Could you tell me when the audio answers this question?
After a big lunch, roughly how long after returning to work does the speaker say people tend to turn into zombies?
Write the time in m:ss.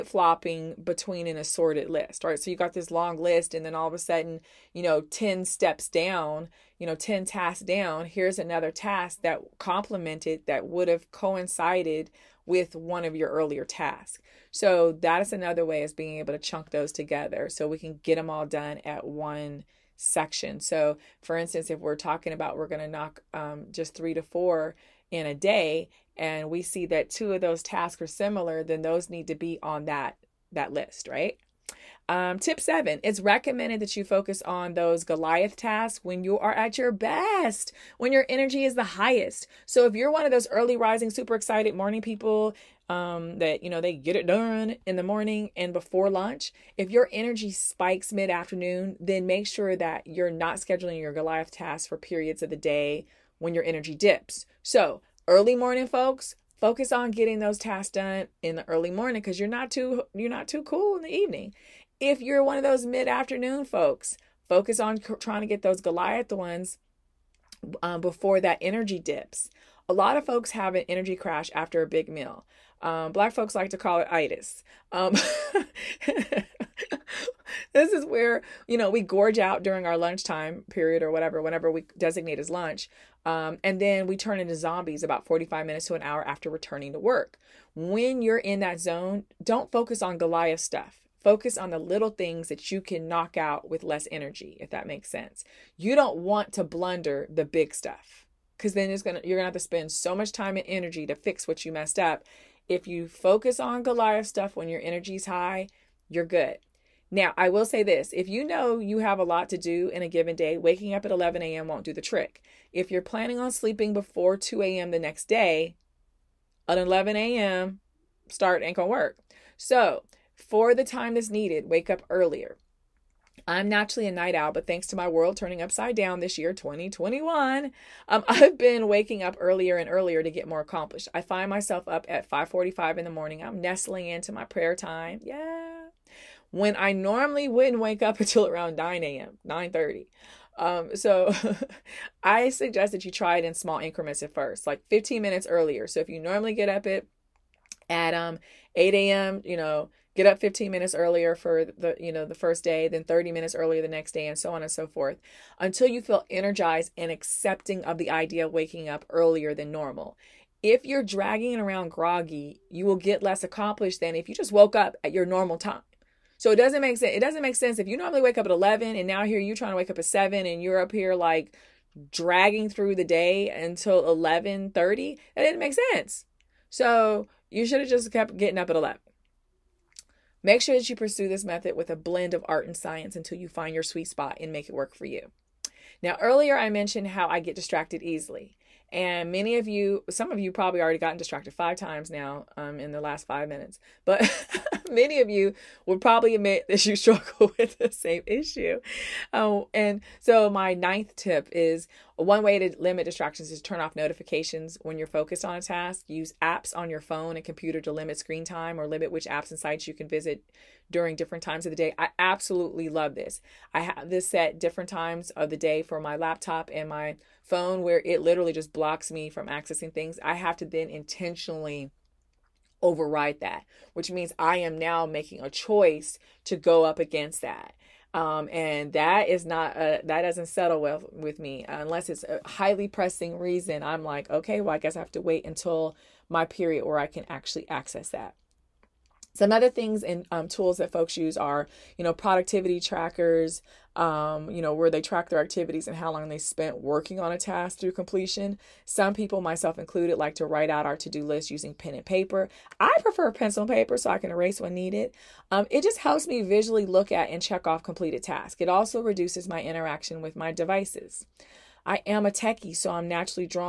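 1:25.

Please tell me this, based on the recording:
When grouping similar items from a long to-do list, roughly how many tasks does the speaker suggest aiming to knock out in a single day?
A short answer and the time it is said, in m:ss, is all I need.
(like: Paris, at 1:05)
3 to 4, at 0:23.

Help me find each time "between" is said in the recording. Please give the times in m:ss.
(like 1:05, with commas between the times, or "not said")
0:00.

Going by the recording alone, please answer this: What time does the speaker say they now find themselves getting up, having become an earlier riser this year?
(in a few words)
5:45.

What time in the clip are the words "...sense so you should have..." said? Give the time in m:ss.
2:55.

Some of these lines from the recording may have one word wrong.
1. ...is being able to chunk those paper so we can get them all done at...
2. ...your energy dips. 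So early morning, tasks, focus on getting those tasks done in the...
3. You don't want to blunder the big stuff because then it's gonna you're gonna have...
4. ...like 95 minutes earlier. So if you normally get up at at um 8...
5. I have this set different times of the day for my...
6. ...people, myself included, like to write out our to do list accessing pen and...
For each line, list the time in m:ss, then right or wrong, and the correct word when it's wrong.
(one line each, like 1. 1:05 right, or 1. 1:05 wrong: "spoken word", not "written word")
1. 0:15 wrong: "together", not "paper"
2. 0:53 wrong: "folks", not "tasks"
3. 1:35 right
4. 2:24 wrong: "15", not "95"
5. 3:33 right
6. 4:09 wrong: "using", not "accessing".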